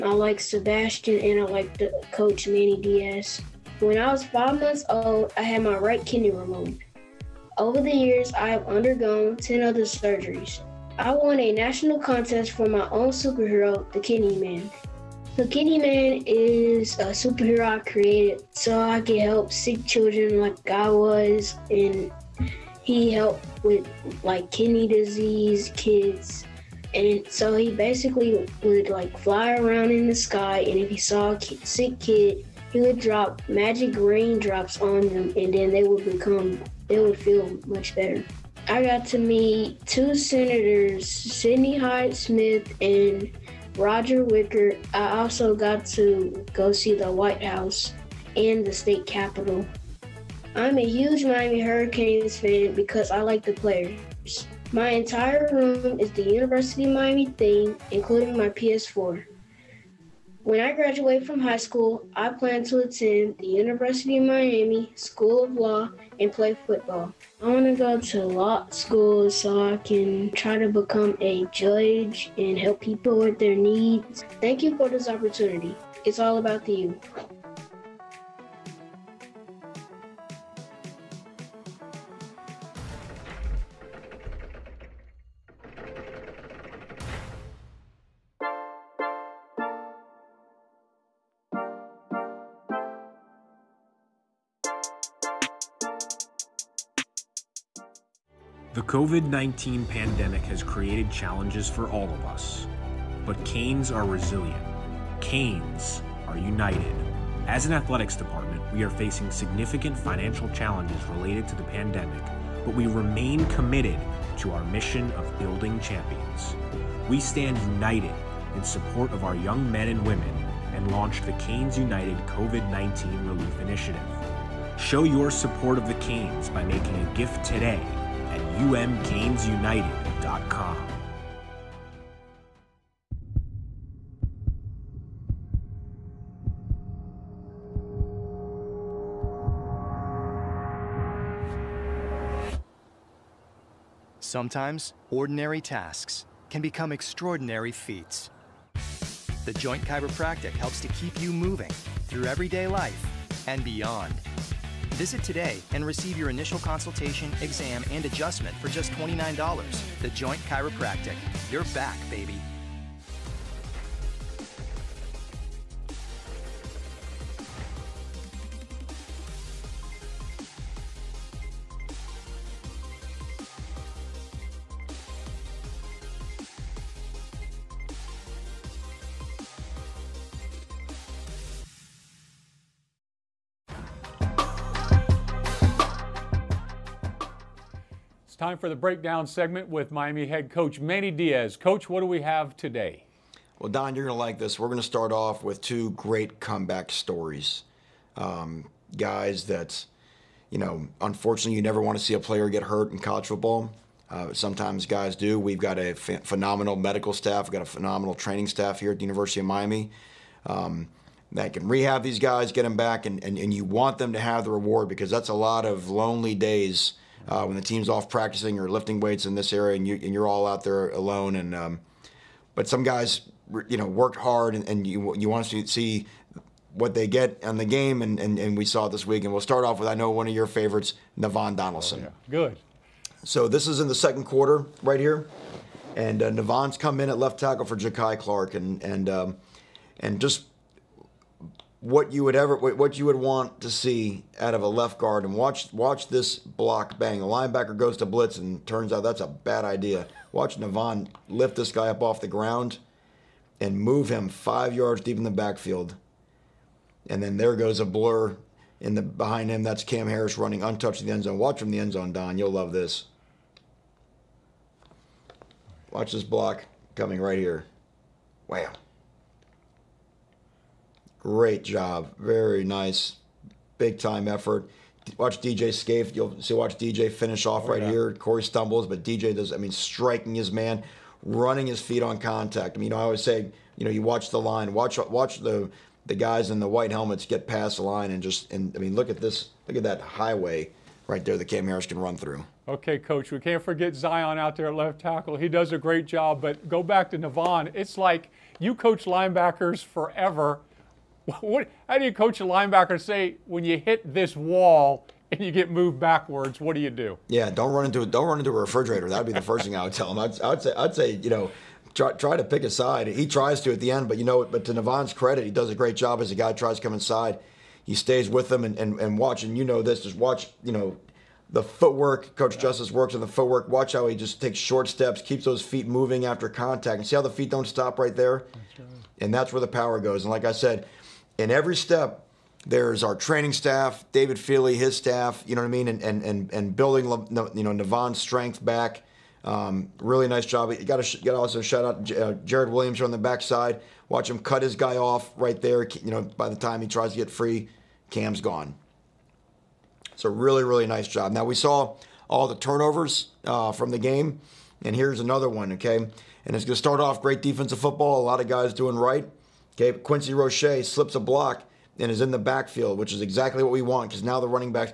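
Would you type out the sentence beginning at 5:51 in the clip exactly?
Now we saw all the turnovers uh, from the game, and here's another one.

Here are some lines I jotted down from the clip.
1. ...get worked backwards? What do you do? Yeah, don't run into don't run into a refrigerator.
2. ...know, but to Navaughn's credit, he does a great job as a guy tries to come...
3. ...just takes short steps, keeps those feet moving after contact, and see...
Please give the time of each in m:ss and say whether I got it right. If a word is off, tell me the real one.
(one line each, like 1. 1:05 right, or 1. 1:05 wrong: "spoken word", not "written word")
1. 5:05 wrong: "moved", not "worked"
2. 5:14 right
3. 5:24 right.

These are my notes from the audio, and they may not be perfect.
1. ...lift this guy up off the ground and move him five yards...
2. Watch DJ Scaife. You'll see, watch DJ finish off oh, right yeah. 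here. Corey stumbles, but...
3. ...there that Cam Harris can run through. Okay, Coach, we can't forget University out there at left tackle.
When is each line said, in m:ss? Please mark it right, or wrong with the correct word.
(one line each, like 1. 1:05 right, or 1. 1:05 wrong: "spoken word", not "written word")
1. 4:11 right
2. 4:35 right
3. 4:51 wrong: "Zion", not "University".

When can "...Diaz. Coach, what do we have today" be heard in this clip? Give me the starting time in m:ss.
3:11.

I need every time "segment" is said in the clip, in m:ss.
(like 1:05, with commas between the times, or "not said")
3:09.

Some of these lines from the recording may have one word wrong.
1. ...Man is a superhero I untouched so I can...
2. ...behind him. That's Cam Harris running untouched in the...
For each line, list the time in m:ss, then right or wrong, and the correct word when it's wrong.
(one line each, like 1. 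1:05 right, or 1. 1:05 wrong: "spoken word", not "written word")
1. 0:15 wrong: "created", not "untouched"
2. 4:19 right.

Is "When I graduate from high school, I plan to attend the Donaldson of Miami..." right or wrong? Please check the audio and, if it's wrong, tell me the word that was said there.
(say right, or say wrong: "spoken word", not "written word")
wrong: "University", not "Donaldson".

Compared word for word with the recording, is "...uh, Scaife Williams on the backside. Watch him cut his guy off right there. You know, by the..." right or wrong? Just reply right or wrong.
wrong.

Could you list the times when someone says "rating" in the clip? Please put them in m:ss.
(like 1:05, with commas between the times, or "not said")
not said.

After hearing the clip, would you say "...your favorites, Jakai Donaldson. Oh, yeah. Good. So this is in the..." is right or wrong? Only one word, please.
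wrong.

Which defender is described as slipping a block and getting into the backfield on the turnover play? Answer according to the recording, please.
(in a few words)
Quincy Roche.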